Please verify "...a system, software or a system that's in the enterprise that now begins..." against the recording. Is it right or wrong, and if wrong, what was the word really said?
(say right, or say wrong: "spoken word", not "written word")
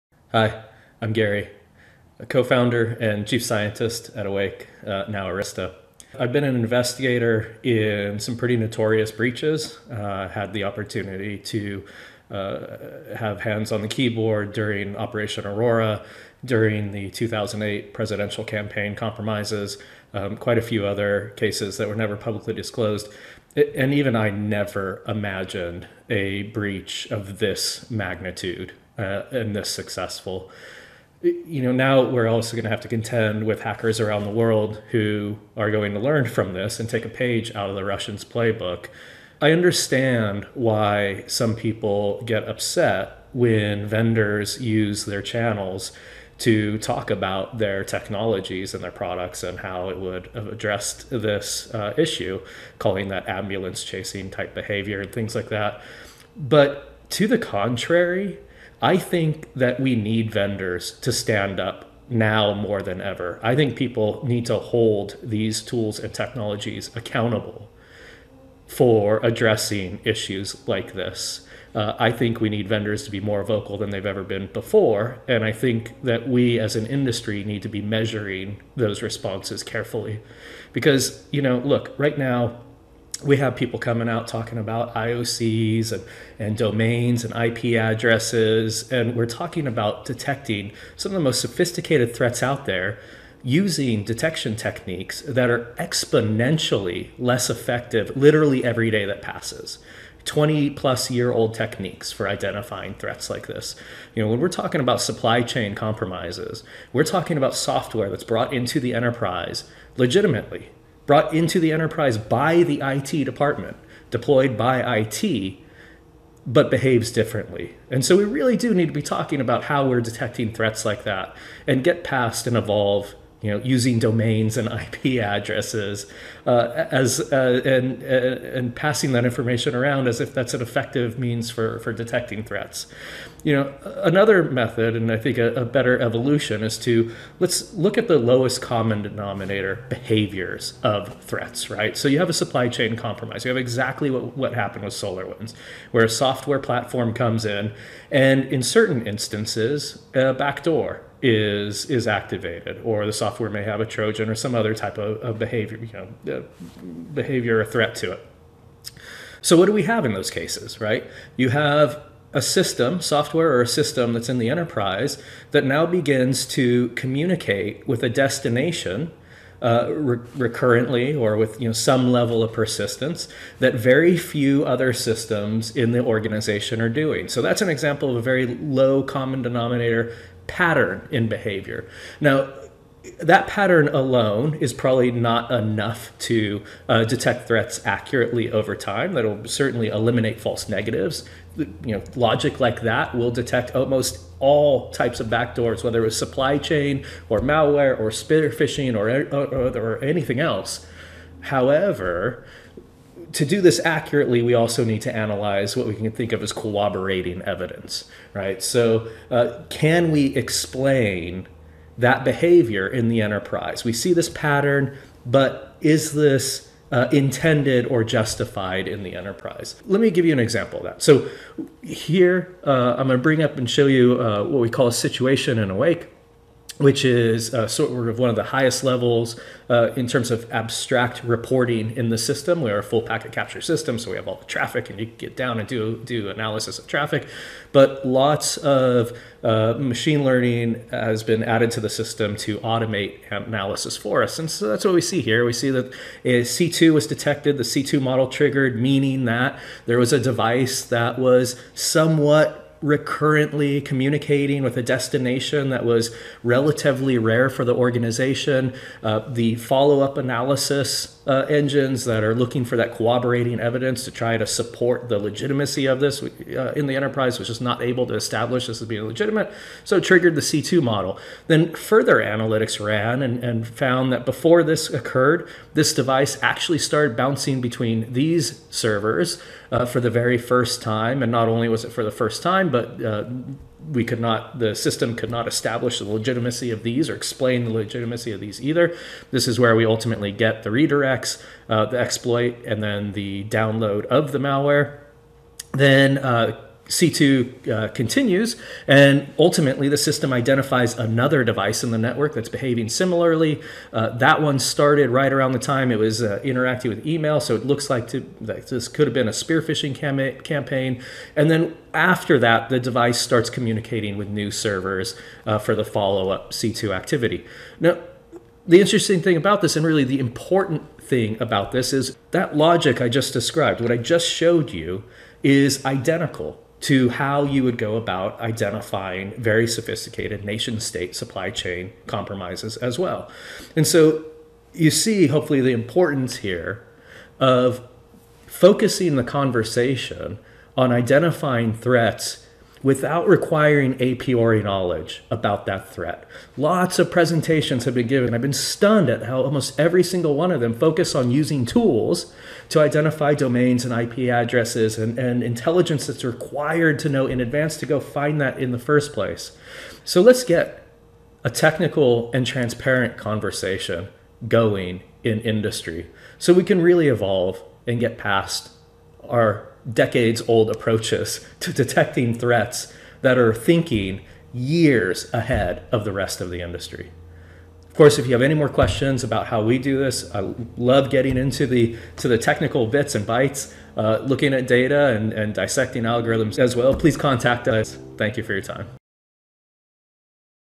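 right.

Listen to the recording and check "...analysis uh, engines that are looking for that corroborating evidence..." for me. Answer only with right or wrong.
right.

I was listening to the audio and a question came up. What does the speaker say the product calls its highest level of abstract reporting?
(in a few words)
A situation.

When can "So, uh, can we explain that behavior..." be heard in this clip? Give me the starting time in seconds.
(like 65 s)
208 s.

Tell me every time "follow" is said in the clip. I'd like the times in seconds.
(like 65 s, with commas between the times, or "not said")
259 s, 315 s.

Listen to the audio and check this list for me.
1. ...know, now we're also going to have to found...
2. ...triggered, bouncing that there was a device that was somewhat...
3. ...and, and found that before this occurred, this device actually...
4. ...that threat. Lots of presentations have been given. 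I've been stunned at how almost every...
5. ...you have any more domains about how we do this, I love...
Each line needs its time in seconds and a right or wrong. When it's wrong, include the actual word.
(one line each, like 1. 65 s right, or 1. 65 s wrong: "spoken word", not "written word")
1. 31 s wrong: "contend", not "found"
2. 248 s wrong: "meaning", not "bouncing"
3. 273 s right
4. 345 s right
5. 378 s wrong: "questions", not "domains".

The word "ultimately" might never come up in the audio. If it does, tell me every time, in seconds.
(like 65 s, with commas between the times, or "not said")
289 s, 299 s.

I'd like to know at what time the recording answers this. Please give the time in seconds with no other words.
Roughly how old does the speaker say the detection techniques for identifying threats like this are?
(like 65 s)
100 s.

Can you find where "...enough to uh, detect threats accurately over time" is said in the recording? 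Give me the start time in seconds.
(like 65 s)
185 s.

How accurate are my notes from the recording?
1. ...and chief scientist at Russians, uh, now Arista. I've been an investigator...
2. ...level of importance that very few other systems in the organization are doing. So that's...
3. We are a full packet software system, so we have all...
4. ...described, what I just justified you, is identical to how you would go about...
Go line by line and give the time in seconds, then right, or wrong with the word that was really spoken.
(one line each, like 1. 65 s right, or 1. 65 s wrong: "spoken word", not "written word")
1. 3 s wrong: "Awake", not "Russians"
2. 172 s wrong: "persistence", not "importance"
3. 232 s wrong: "capture", not "software"
4. 323 s wrong: "showed", not "justified".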